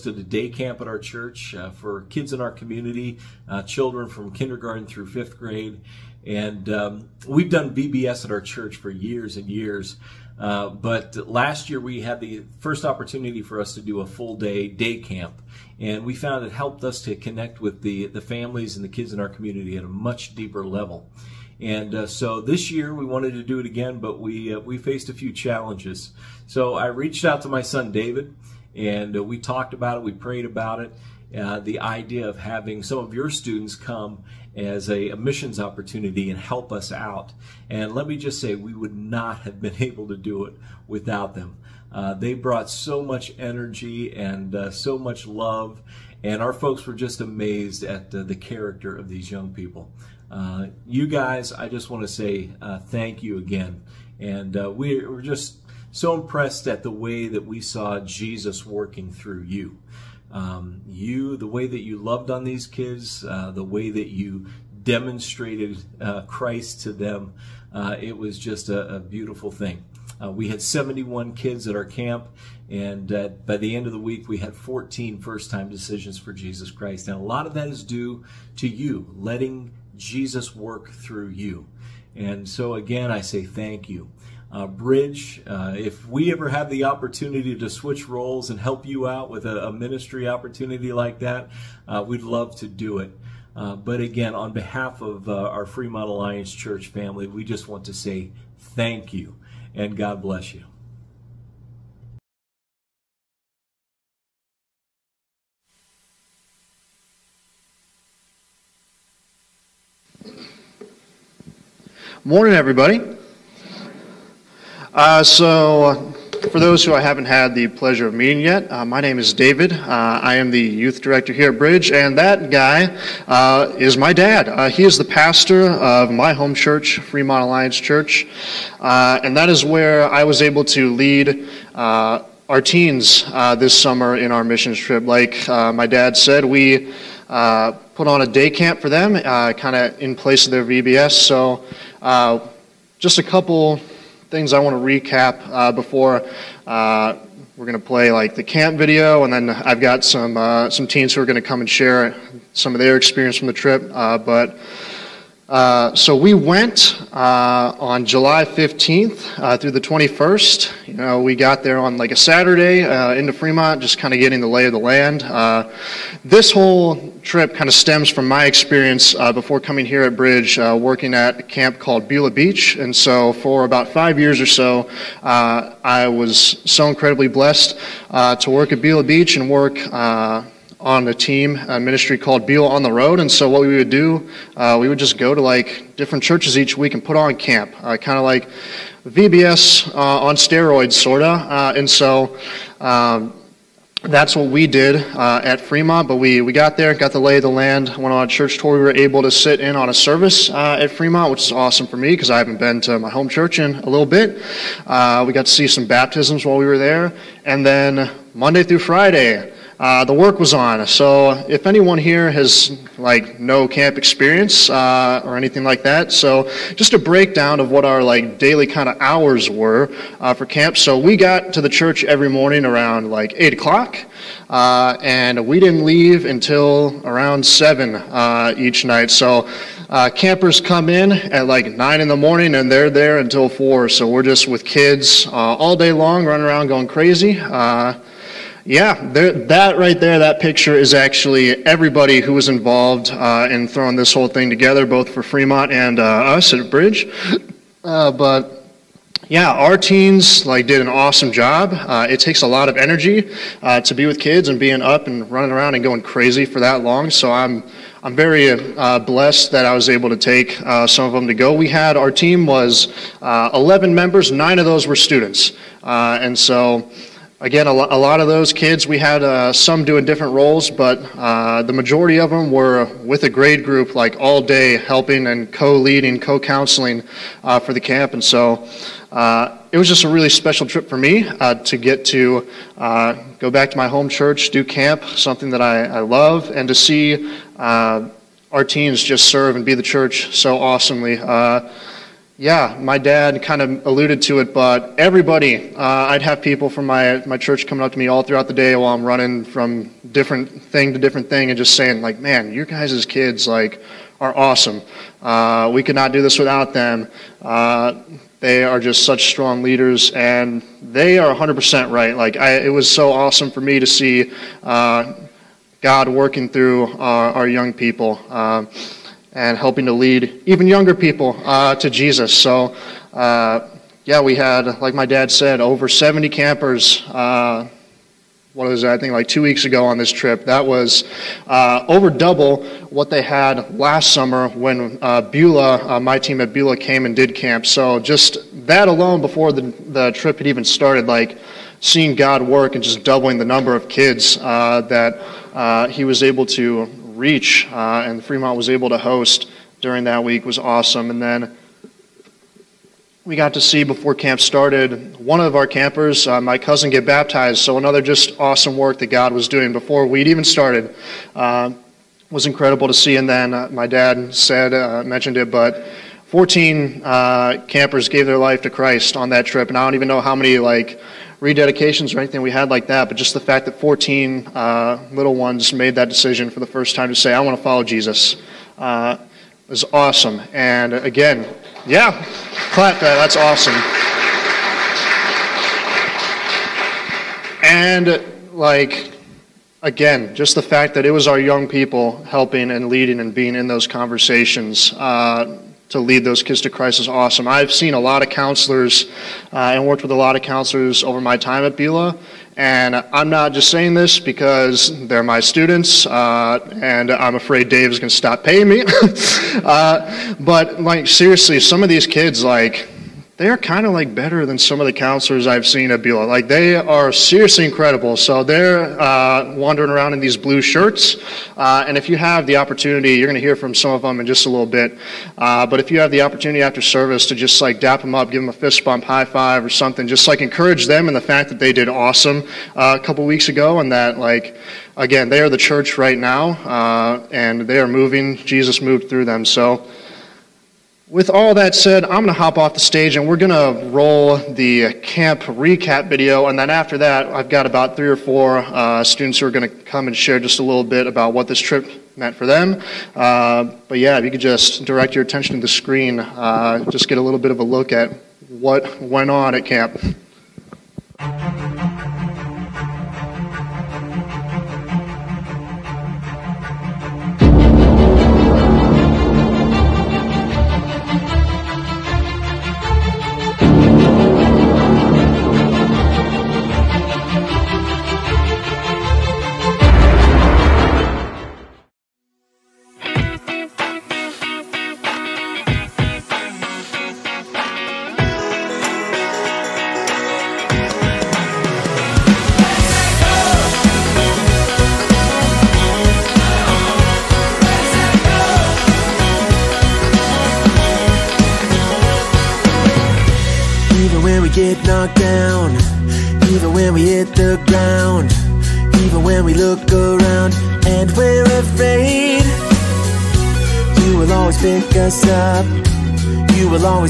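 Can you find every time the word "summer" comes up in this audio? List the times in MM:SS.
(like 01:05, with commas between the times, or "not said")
02:13, 05:34.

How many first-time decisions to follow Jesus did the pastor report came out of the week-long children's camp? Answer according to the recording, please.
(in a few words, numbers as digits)
14.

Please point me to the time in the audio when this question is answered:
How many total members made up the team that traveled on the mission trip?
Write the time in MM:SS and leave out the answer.
04:23.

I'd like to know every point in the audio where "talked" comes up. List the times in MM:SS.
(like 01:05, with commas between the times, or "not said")
00:29.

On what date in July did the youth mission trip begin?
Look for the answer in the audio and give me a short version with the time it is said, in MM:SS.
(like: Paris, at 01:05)
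July 15, at 02:38.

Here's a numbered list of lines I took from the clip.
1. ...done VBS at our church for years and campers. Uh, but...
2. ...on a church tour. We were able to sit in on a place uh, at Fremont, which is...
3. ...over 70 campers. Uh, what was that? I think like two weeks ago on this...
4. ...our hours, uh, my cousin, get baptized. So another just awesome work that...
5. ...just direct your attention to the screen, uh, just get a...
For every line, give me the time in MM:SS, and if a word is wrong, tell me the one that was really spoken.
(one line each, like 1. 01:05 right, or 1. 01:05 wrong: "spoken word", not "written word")
1. 00:07 wrong: "years", not "campers"
2. 03:18 wrong: "service", not "place"
3. 05:25 right
4. 05:55 wrong: "campers", not "hours"
5. 07:34 right.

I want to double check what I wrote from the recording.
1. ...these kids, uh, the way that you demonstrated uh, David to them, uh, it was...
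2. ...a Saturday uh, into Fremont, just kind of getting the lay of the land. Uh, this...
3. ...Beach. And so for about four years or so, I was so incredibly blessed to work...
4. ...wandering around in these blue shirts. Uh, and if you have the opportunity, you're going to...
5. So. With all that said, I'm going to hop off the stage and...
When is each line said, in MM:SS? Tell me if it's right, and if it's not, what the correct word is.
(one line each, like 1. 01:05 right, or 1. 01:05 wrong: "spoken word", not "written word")
1. 01:02 wrong: "Christ", not "David"
2. 02:42 right
3. 02:52 wrong: "five", not "four"
4. 06:59 right
5. 07:19 right.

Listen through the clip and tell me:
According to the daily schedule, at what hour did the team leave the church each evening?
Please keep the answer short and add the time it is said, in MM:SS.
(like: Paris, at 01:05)
7, at 03:47.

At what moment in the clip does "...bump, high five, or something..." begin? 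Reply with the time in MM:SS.
07:08.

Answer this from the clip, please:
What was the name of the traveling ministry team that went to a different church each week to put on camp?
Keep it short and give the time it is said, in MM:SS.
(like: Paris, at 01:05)
Beulah on the Road, at 03:02.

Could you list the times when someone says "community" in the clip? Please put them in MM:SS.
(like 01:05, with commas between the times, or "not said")
00:02, 00:19.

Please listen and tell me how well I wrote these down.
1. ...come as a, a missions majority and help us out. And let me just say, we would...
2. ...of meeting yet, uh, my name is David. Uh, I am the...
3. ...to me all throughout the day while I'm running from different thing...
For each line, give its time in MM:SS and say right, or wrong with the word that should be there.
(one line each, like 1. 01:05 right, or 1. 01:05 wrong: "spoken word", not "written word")
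1. 00:33 wrong: "opportunity", not "majority"
2. 01:58 right
3. 04:57 right.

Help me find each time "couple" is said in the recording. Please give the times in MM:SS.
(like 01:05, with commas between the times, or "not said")
02:23, 07:13.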